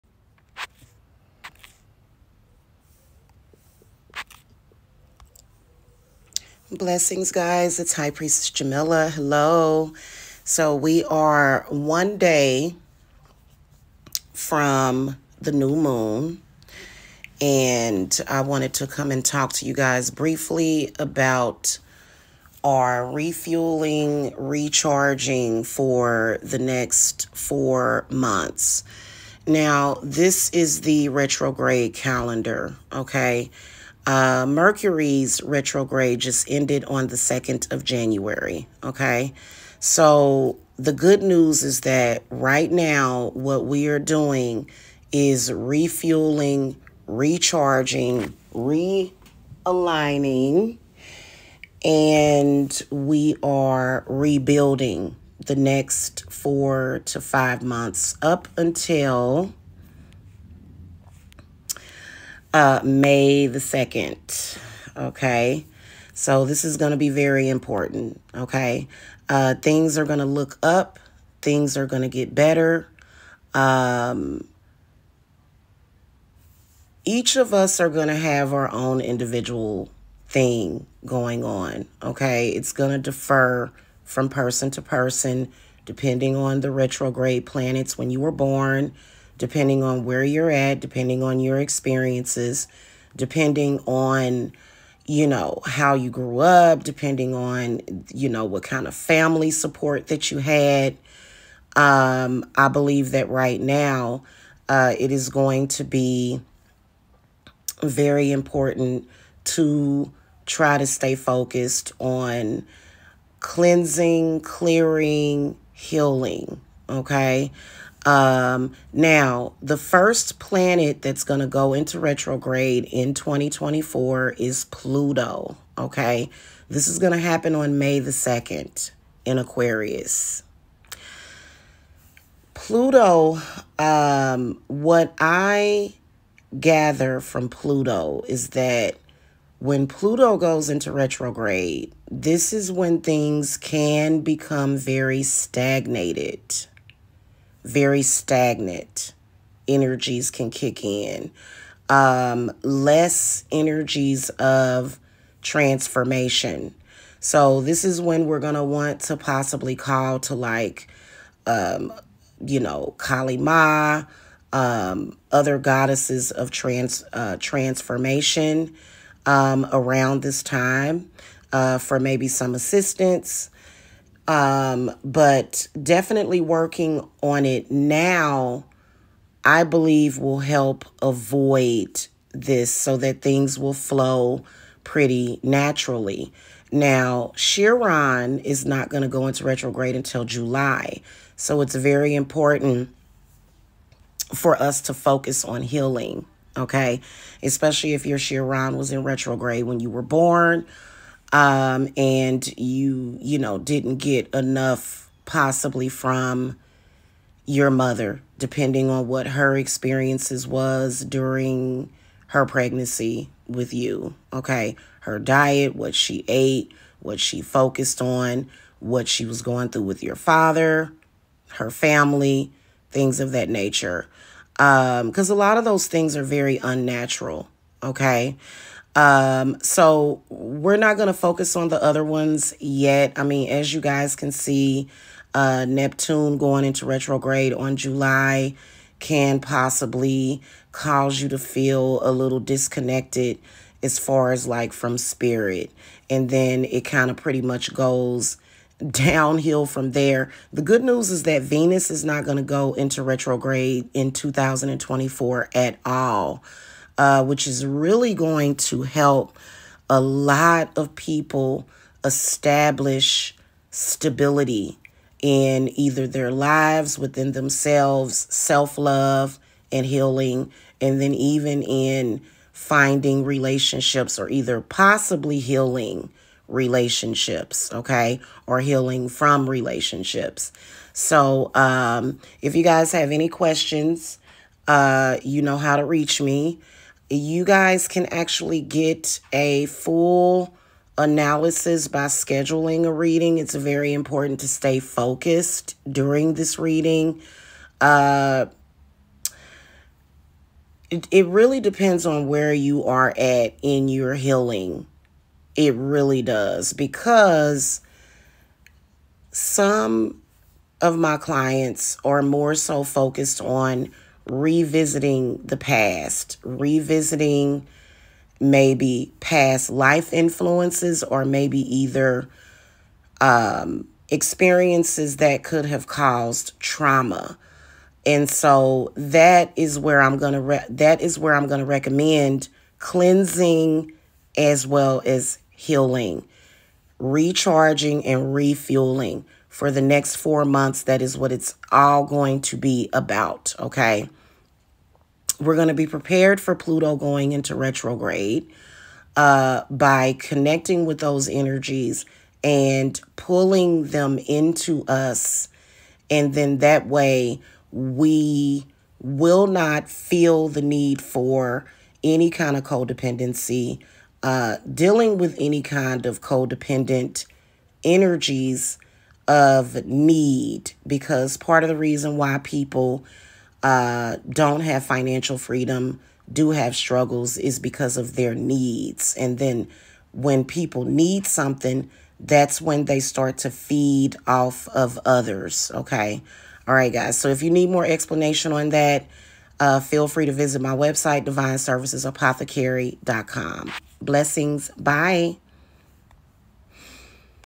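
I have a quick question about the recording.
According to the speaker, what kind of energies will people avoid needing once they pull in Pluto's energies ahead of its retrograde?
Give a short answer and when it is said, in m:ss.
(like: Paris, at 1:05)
codependent energies, at 6:06.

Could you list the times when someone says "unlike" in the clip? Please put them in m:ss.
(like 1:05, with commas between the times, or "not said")
not said.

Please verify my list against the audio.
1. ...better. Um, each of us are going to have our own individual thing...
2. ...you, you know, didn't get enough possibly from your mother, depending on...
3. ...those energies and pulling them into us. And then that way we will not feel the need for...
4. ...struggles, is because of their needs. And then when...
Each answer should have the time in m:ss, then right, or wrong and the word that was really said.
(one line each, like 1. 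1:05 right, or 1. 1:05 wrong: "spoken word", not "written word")
1. 1:12 right
2. 3:22 right
3. 5:50 right
4. 6:16 right.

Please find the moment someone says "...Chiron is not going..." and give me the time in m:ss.
3:07.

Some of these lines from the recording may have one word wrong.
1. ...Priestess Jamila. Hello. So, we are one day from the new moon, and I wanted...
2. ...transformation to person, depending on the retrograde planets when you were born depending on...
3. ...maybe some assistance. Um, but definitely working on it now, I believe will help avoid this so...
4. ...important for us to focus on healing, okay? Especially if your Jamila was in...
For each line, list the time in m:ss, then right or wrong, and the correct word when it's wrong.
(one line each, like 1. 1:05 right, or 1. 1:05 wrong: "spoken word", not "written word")
1. 0:08 right
2. 1:24 wrong: "person", not "transformation"
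3. 2:51 right
4. 3:12 wrong: "Chiron", not "Jamila".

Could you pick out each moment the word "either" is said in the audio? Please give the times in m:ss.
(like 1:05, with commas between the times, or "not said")
4:25, 4:34, 5:21.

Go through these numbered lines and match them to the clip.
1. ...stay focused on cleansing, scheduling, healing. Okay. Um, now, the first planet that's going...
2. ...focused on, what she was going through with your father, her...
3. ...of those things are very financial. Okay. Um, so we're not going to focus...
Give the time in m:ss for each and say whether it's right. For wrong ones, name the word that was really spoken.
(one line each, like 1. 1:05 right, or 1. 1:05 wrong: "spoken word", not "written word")
1. 1:50 wrong: "clearing", not "scheduling"
2. 3:37 right
3. 3:45 wrong: "unnatural", not "financial".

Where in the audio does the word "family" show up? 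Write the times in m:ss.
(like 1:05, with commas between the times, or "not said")
1:38, 3:41.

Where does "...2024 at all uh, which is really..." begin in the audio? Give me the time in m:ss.
4:14.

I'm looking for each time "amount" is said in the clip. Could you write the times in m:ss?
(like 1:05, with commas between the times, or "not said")
not said.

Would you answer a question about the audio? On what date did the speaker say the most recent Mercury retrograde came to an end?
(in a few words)
January 2.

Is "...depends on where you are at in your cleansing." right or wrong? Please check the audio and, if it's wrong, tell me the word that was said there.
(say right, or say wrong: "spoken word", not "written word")
wrong: "healing", not "cleansing".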